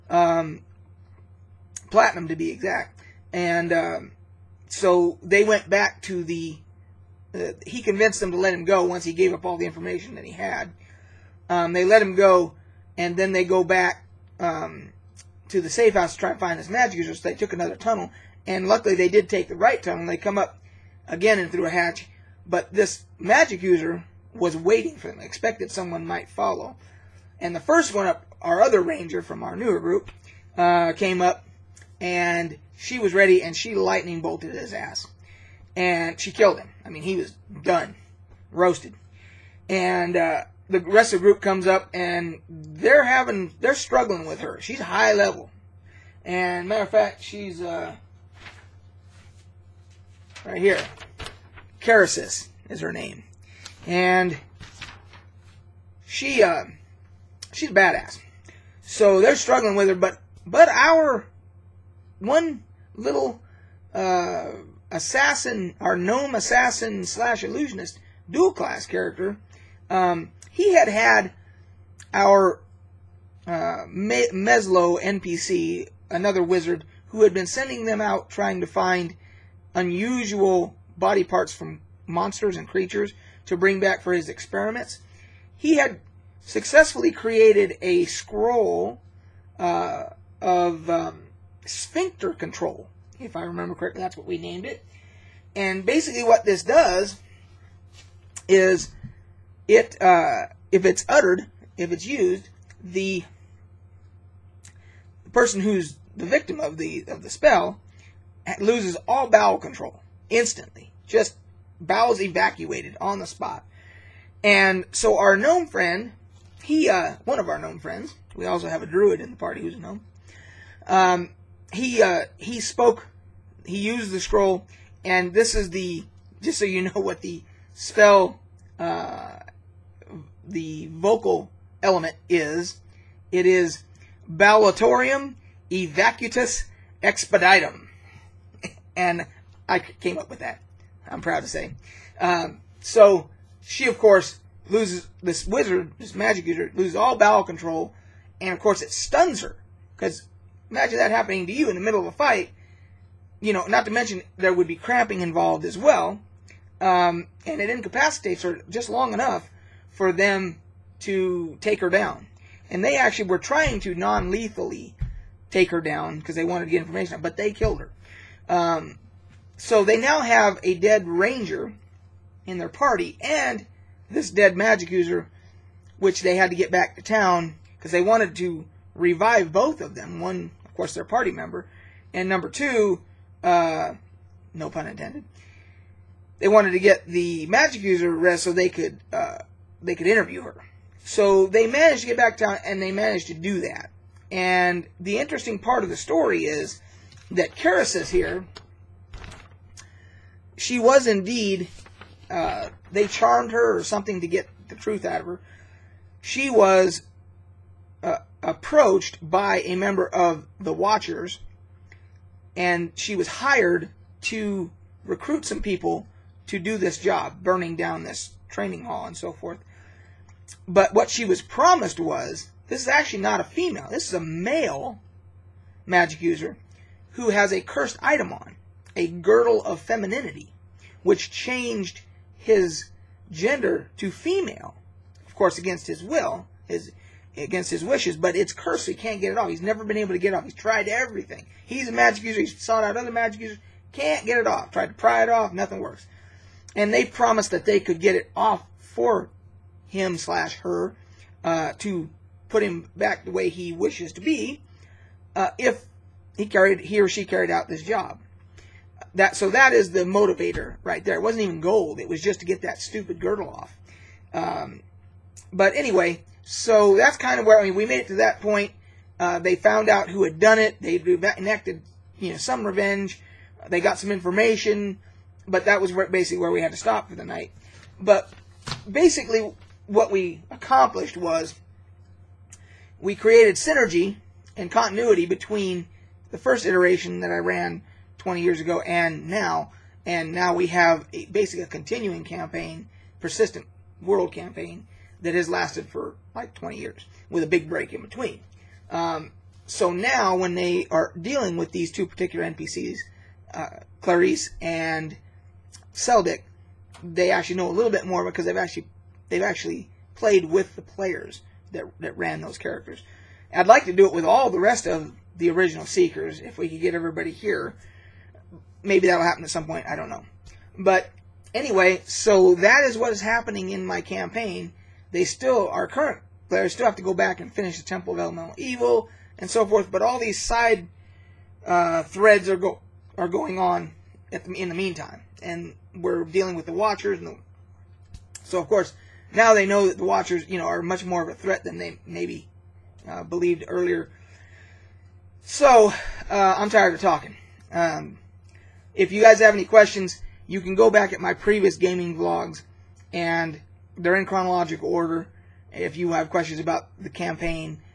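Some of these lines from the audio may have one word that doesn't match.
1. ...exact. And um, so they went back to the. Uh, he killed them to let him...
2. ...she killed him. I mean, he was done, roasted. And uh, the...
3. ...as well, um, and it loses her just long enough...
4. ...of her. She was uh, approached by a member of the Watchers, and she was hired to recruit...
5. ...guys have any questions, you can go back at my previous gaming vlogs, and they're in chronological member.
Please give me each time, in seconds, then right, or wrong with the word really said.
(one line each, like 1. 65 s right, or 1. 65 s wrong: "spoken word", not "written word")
1. 2 s wrong: "convinced", not "killed"
2. 36 s right
3. 155 s wrong: "incapacitates", not "loses"
4. 205 s right
5. 349 s wrong: "order", not "member".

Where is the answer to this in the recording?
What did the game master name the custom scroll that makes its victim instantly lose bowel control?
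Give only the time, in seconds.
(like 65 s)
91 s.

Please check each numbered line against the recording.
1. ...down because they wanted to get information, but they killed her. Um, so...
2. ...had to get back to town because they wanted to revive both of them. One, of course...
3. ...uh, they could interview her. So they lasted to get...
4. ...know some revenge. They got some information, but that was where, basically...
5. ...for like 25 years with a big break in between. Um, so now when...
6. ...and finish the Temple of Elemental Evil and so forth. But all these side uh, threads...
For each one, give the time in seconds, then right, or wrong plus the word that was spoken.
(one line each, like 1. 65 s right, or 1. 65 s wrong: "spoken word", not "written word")
1. 165 s right
2. 176 s right
3. 189 s wrong: "managed", not "lasted"
4. 272 s right
5. 295 s wrong: "20", not "25"
6. 327 s right.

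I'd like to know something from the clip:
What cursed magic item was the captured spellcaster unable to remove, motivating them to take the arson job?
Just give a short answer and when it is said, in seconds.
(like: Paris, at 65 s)
girdle of femininity, at 229 s.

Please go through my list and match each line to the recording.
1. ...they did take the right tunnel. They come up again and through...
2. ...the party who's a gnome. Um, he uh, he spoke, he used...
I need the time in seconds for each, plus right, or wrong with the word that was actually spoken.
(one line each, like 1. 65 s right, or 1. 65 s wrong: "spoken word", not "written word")
1. 18 s right
2. 119 s right.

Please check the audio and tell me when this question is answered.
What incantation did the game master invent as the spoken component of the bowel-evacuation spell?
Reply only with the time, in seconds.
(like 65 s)
134 s.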